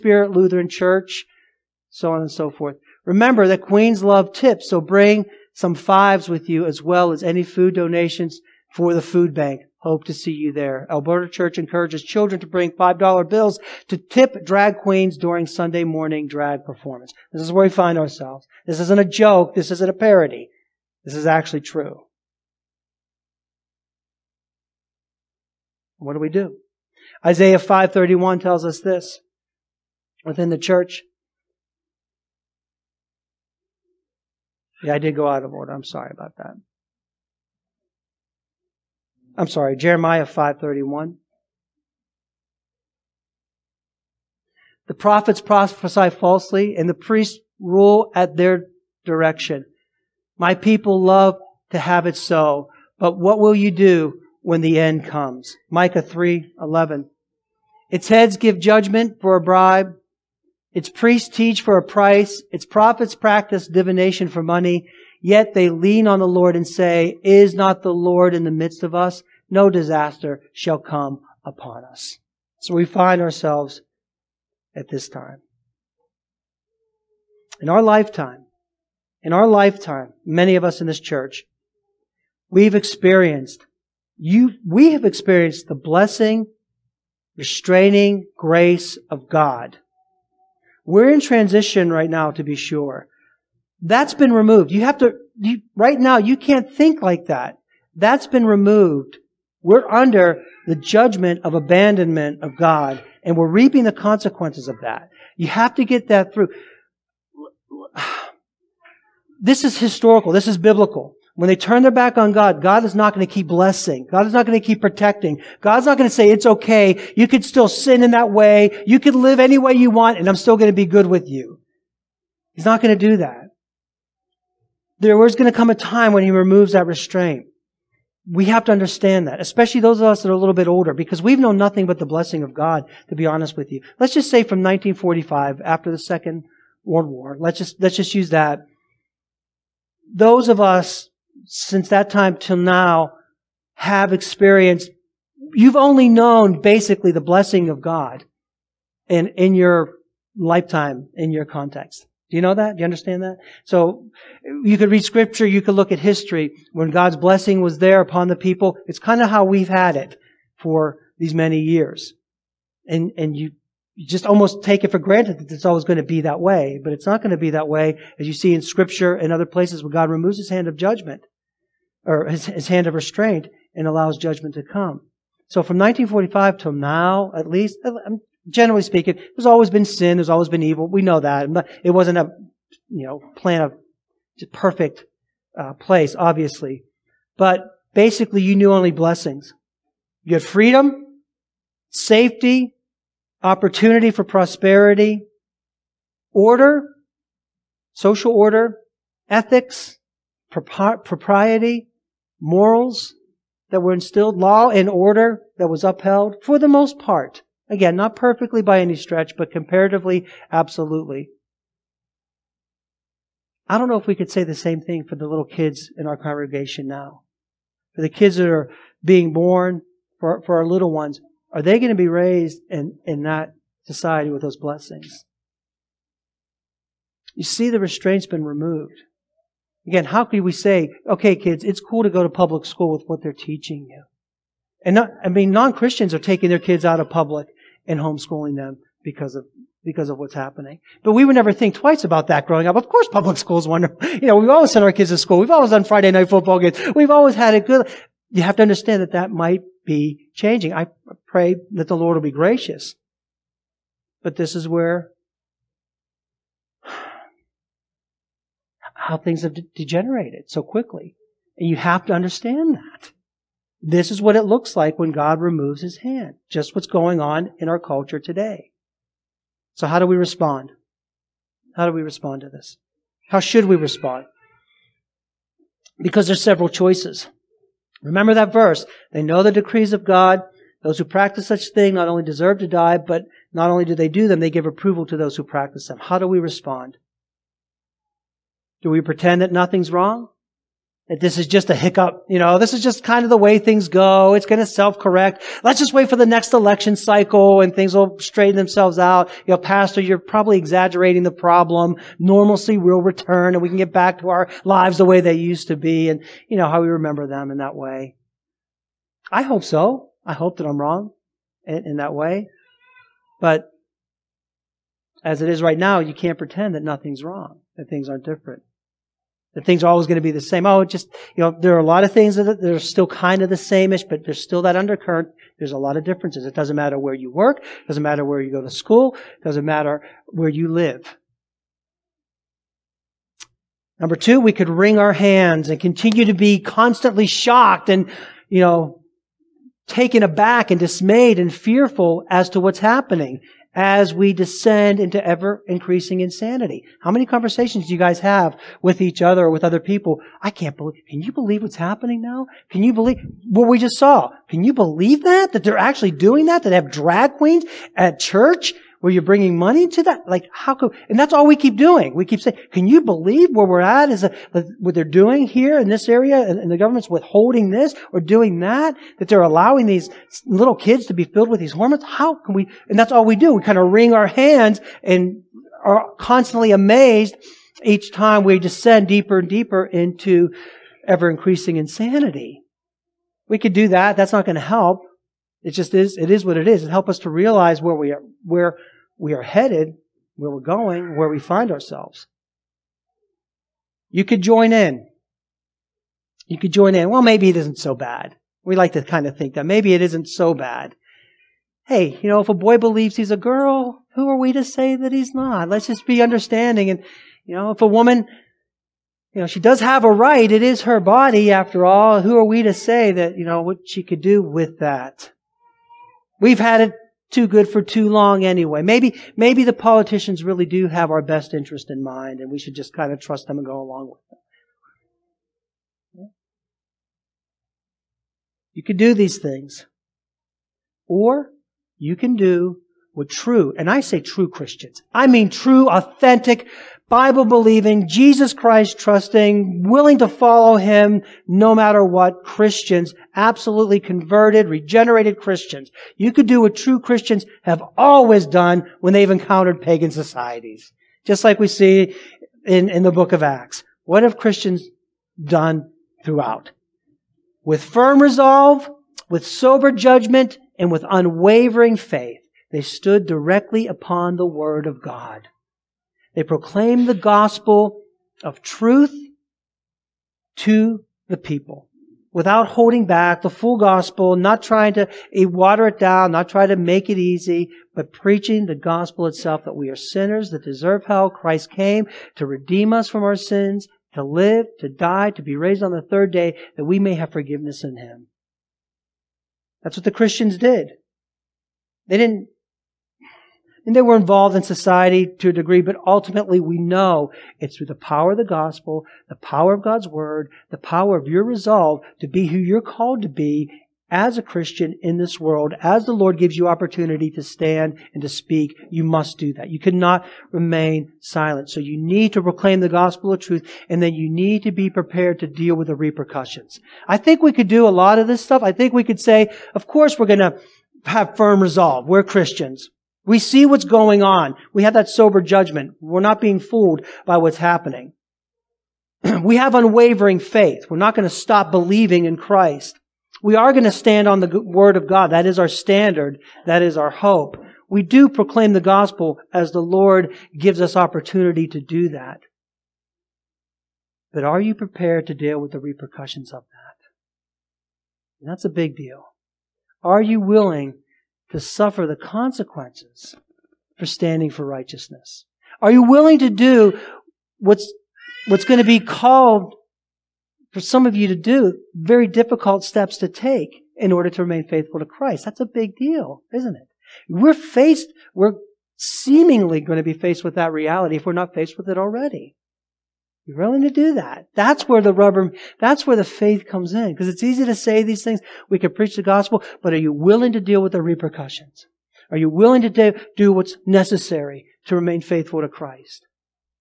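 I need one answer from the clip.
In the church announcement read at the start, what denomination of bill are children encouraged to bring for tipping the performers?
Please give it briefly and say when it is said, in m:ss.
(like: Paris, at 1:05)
$5 bills, at 0:12.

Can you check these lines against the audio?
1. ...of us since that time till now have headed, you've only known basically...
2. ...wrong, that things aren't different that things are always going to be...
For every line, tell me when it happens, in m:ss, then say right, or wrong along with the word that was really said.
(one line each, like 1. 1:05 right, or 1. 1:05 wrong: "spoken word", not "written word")
1. 2:20 wrong: "experienced", not "headed"
2. 5:17 right.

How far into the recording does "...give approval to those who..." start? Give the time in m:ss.
4:44.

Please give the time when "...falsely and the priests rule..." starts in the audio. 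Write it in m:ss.
0:46.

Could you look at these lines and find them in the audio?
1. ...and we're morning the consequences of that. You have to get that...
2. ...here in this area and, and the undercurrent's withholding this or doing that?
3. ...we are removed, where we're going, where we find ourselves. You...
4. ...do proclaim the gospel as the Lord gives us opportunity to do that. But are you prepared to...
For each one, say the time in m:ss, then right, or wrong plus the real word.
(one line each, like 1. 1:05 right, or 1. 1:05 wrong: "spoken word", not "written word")
1. 1:43 wrong: "reaping", not "morning"
2. 6:05 wrong: "government", not "undercurrent"
3. 6:29 wrong: "headed", not "removed"
4. 8:58 right.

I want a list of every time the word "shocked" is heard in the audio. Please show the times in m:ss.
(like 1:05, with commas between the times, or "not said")
5:37.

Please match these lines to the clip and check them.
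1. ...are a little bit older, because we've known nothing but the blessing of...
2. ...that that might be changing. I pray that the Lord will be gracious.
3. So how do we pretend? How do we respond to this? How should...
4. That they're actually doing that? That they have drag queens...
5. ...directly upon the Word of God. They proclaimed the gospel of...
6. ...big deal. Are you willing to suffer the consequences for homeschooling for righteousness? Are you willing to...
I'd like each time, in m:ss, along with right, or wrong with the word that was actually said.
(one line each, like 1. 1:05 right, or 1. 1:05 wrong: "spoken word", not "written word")
1. 2:10 right
2. 4:09 right
3. 4:29 wrong: "respond", not "pretend"
4. 5:55 right
5. 7:43 right
6. 9:08 wrong: "standing", not "homeschooling".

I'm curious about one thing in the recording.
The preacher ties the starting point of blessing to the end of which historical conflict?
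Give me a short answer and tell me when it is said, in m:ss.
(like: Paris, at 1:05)
Second World War, at 2:15.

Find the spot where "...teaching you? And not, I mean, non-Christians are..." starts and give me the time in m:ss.
3:53.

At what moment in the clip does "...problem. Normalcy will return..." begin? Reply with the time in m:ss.
5:01.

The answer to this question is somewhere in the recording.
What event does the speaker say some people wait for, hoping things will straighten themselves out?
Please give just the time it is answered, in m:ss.
4:56.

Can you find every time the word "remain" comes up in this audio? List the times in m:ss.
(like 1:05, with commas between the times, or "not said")
8:30, 9:24, 9:44.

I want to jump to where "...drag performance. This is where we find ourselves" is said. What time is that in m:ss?
0:16.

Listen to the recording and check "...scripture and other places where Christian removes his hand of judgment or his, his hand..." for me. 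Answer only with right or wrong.
wrong.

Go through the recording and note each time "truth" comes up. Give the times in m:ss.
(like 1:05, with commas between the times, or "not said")
7:48, 8:33.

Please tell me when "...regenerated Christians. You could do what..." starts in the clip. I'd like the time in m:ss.
7:24.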